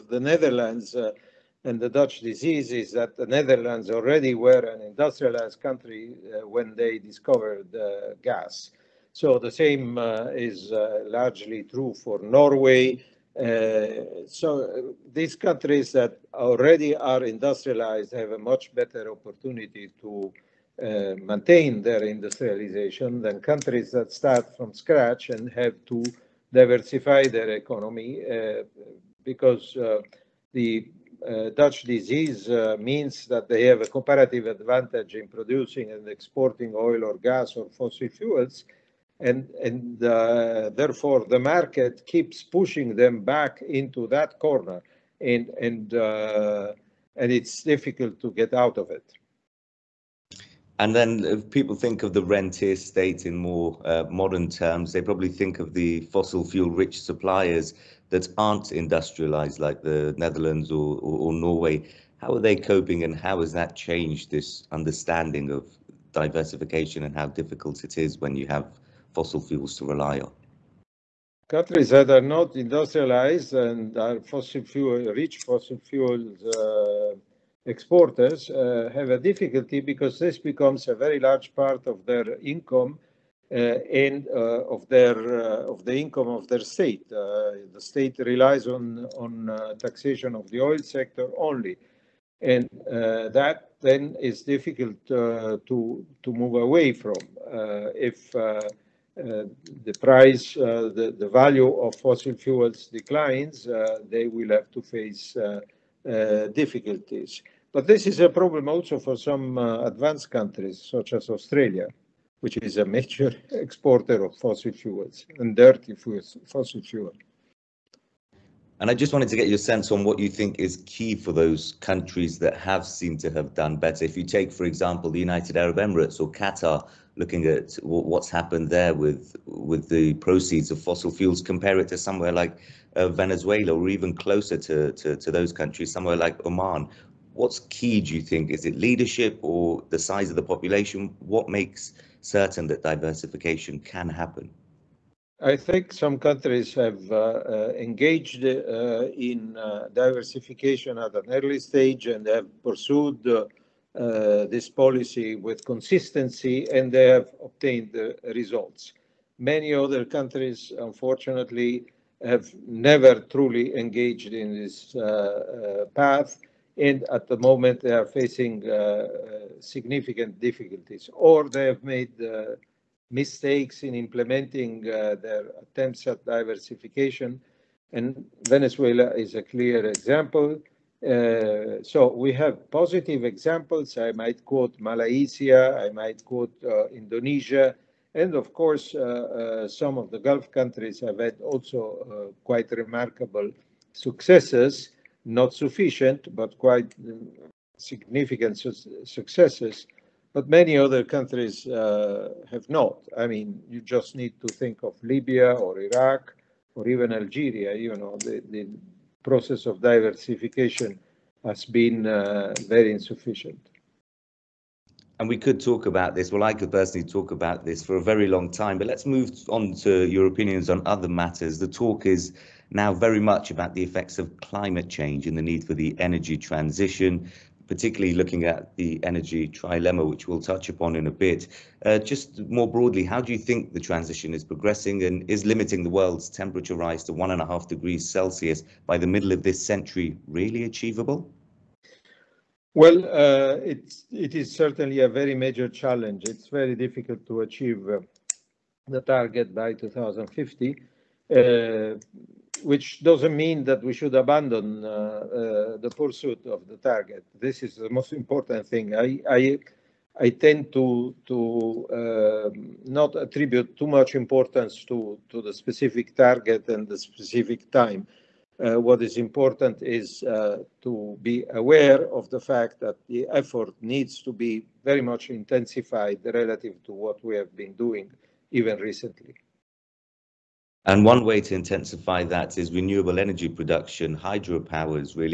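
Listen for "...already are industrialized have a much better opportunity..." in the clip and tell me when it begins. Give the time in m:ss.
0:16.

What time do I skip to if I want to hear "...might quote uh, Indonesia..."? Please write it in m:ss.
3:05.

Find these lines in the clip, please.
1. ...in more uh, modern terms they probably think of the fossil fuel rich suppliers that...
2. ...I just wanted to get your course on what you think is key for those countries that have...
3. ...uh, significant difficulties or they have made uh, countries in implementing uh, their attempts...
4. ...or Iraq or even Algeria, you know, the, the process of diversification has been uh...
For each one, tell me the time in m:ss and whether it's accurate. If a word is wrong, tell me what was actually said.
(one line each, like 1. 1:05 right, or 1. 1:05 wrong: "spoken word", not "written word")
1. 0:53 right
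2. 1:58 wrong: "sense", not "course"
3. 2:48 wrong: "mistakes", not "countries"
4. 3:25 right.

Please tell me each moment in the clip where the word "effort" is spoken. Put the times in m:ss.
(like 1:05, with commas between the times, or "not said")
4:33.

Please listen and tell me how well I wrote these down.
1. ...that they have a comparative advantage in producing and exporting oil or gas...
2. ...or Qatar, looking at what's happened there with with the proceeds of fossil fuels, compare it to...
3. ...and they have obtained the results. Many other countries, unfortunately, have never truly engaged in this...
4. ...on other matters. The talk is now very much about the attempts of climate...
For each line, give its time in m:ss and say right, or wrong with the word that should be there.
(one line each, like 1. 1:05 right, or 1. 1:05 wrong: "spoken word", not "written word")
1. 0:33 right
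2. 2:06 right
3. 2:36 right
4. 3:40 wrong: "effects", not "attempts".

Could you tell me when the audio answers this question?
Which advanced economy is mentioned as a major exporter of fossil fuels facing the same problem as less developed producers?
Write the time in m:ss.
1:51.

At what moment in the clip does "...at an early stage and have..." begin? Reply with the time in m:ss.
2:30.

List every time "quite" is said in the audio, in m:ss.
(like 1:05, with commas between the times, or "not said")
3:12, 3:16.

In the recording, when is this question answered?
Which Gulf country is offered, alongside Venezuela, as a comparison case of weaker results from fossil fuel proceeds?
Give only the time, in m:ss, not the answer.
2:16.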